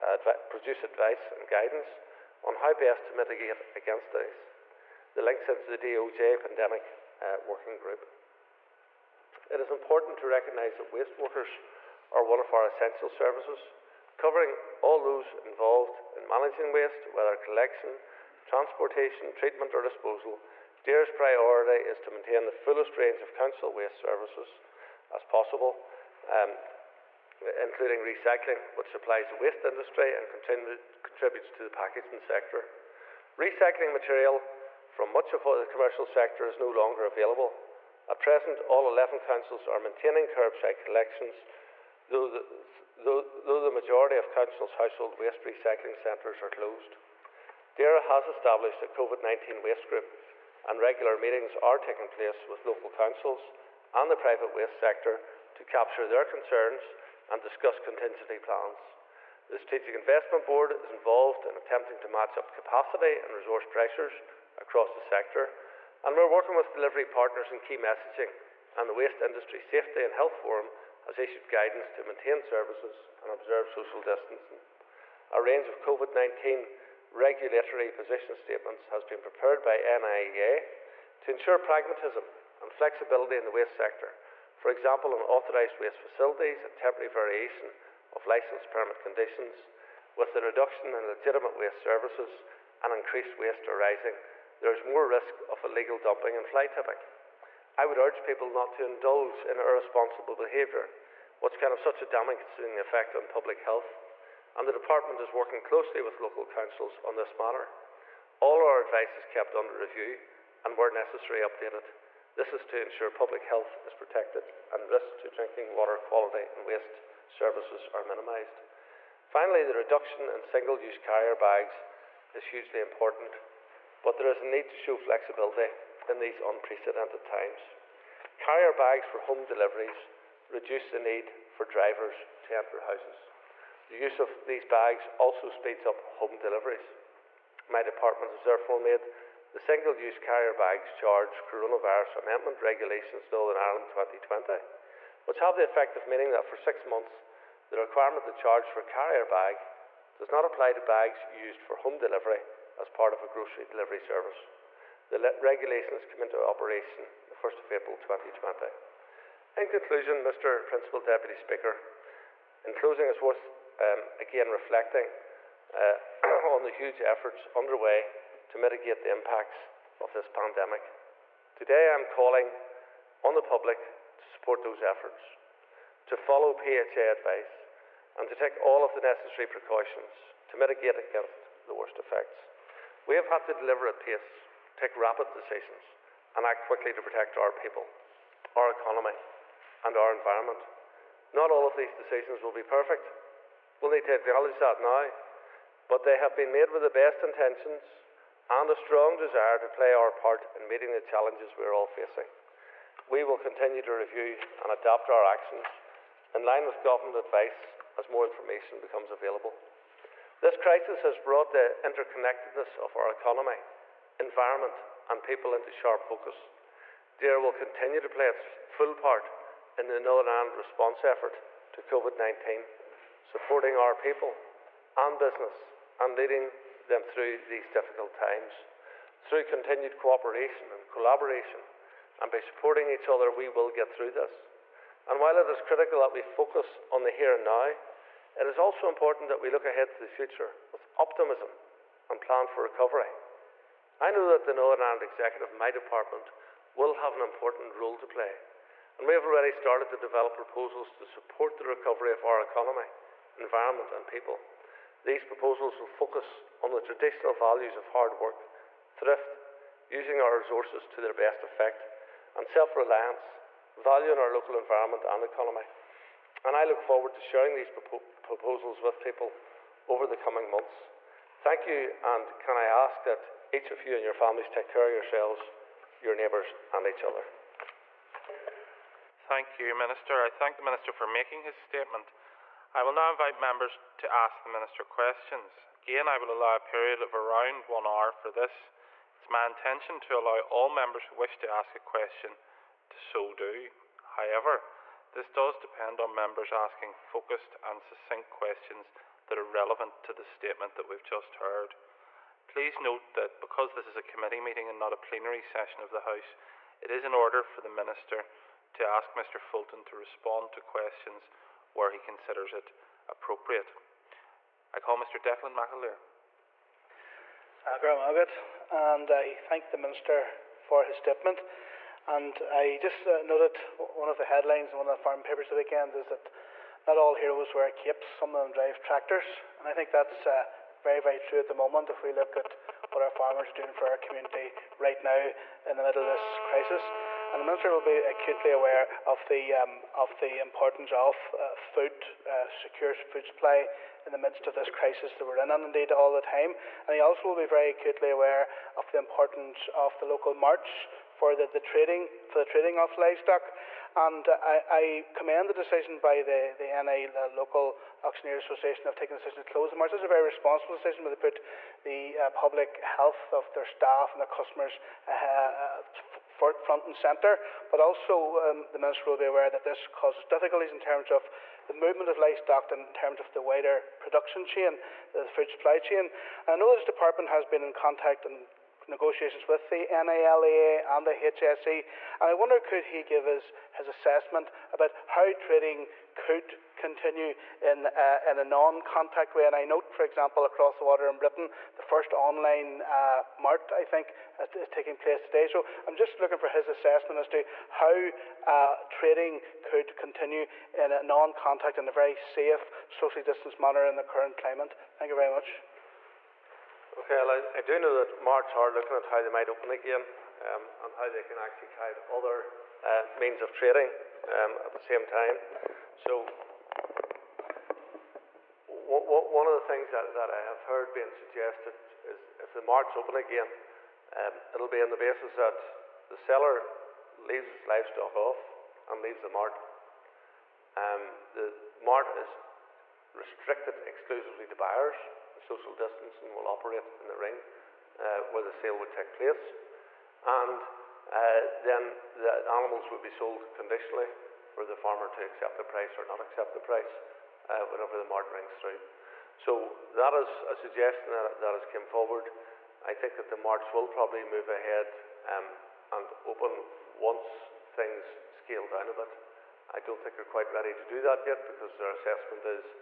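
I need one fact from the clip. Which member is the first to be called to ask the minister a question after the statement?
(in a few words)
Declan McAleer.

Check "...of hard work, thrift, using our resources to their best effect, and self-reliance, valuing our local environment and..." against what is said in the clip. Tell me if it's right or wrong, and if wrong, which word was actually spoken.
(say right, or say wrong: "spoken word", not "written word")
right.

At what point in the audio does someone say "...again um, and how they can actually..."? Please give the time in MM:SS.
06:49.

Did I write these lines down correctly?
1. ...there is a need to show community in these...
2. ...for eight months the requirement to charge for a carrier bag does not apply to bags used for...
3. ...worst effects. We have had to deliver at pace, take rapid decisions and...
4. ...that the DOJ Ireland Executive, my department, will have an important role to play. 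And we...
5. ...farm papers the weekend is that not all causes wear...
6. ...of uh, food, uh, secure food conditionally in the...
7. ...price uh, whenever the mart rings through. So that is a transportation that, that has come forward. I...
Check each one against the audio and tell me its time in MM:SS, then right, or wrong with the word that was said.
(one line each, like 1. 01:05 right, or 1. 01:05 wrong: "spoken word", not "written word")
1. 02:04 wrong: "flexibility", not "community"
2. 02:26 wrong: "six", not "eight"
3. 03:01 right
4. 04:04 wrong: "Northern", not "DOJ"
5. 05:25 wrong: "heroes", not "causes"
6. 05:40 wrong: "supply", not "conditionally"
7. 07:26 wrong: "suggestion", not "transportation".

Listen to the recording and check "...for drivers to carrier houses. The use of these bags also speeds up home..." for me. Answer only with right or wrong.
wrong.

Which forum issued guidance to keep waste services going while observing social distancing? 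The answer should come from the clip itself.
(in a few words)
Waste Industry Safety and Health Forum.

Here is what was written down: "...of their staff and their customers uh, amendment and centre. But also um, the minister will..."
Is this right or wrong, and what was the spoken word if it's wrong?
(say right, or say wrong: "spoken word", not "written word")
wrong: "front", not "amendment".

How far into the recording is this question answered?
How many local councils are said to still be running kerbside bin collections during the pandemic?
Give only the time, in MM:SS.
00:38.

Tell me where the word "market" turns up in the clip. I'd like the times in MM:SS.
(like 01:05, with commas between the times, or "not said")
05:59, 07:02.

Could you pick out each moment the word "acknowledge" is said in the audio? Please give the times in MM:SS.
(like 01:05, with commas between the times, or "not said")
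03:14.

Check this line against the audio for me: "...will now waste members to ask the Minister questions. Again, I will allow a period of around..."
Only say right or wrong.
wrong.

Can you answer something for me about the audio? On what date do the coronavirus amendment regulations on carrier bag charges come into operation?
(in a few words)
1 April 2020.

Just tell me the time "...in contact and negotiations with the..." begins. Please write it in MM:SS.
06:17.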